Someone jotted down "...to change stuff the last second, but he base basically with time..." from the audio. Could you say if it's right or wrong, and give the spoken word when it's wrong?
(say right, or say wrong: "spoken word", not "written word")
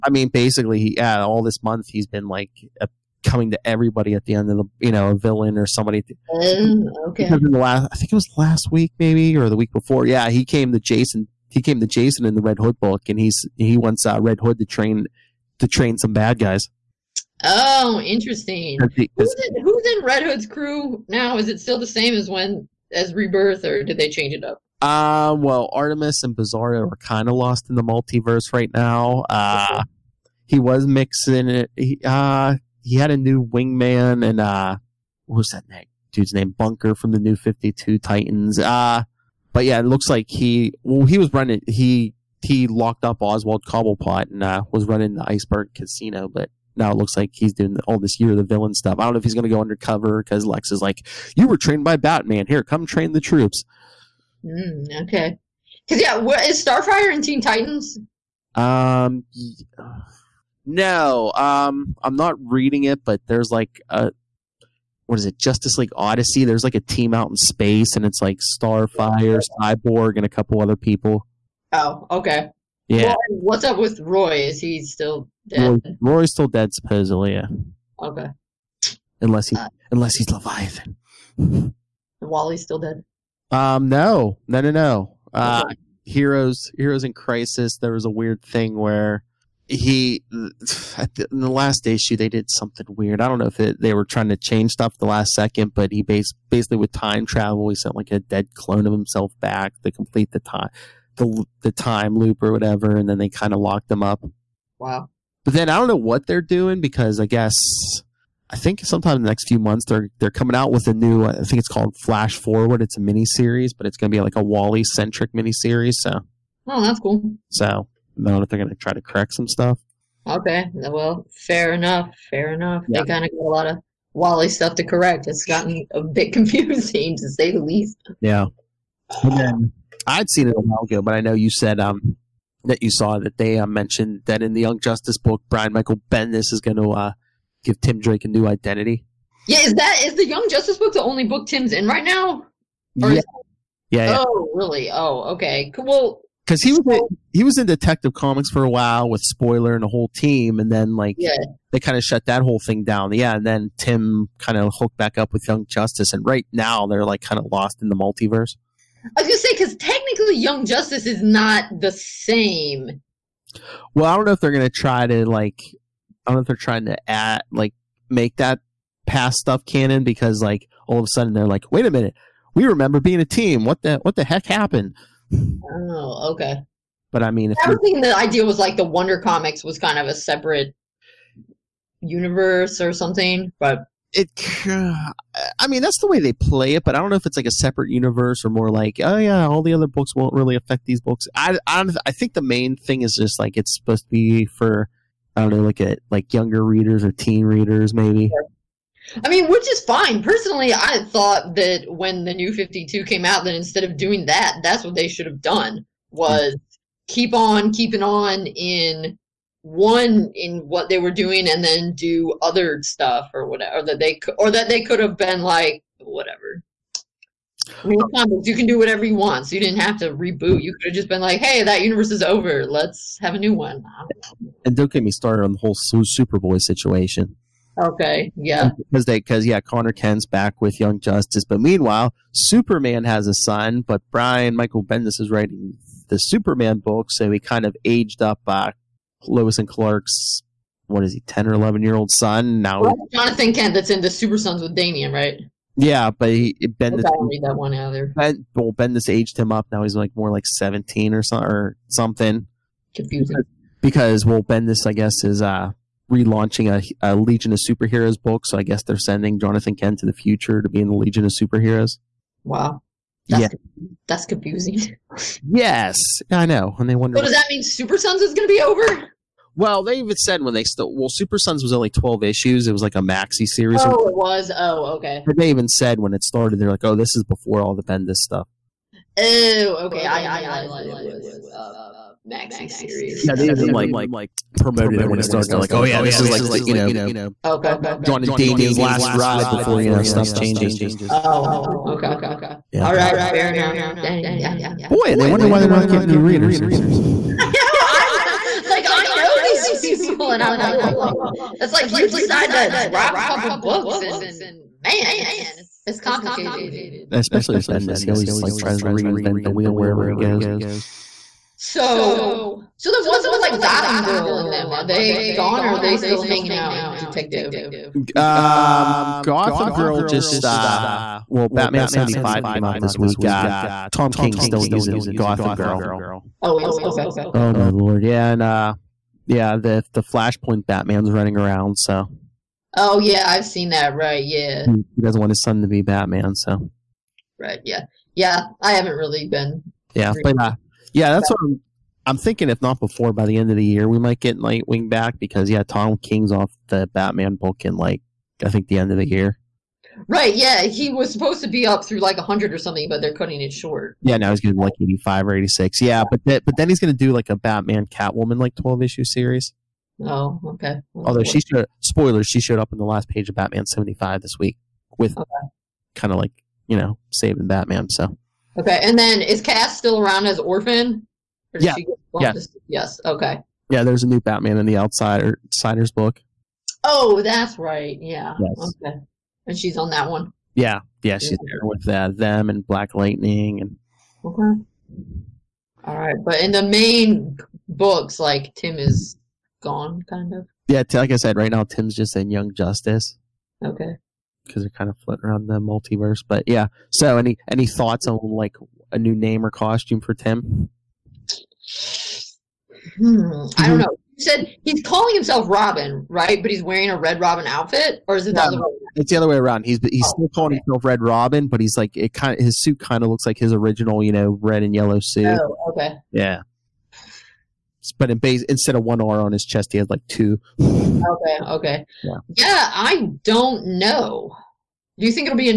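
right.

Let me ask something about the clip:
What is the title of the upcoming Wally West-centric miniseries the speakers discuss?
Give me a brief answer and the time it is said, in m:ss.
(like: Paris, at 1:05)
Flash Forward, at 1:52.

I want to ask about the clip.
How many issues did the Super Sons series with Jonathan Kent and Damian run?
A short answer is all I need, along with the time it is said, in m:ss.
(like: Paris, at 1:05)
12, at 4:31.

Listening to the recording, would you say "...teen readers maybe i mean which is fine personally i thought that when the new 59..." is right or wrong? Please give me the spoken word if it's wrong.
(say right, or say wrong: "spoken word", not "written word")
wrong: "52", not "59".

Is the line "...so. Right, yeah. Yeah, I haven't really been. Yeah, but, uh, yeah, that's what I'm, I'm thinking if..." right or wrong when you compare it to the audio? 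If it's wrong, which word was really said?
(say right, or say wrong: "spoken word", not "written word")
right.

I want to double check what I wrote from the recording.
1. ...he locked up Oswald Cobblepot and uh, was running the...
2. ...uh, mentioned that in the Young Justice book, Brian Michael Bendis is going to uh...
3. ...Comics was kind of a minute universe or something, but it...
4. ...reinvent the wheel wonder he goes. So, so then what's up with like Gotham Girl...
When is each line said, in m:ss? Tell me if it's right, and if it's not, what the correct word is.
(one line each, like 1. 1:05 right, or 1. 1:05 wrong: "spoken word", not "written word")
1. 0:42 right
2. 2:13 right
3. 2:59 wrong: "separate", not "minute"
4. 5:08 wrong: "wherever", not "wonder".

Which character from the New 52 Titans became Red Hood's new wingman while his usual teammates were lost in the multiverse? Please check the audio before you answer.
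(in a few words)
Bunker.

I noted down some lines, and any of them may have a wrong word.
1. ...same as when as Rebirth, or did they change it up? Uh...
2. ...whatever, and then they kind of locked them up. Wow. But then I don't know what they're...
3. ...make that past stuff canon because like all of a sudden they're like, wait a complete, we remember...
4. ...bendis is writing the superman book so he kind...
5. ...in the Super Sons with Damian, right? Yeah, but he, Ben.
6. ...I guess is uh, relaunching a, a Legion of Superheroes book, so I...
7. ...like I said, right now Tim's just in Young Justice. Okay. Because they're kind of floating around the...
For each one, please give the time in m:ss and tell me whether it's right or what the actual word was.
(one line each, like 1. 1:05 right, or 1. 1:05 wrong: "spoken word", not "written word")
1. 0:21 right
2. 1:42 right
3. 2:48 wrong: "minute", not "complete"
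4. 3:54 right
5. 4:03 right
6. 4:14 right
7. 6:30 right.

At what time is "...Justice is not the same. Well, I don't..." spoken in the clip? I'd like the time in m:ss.
2:40.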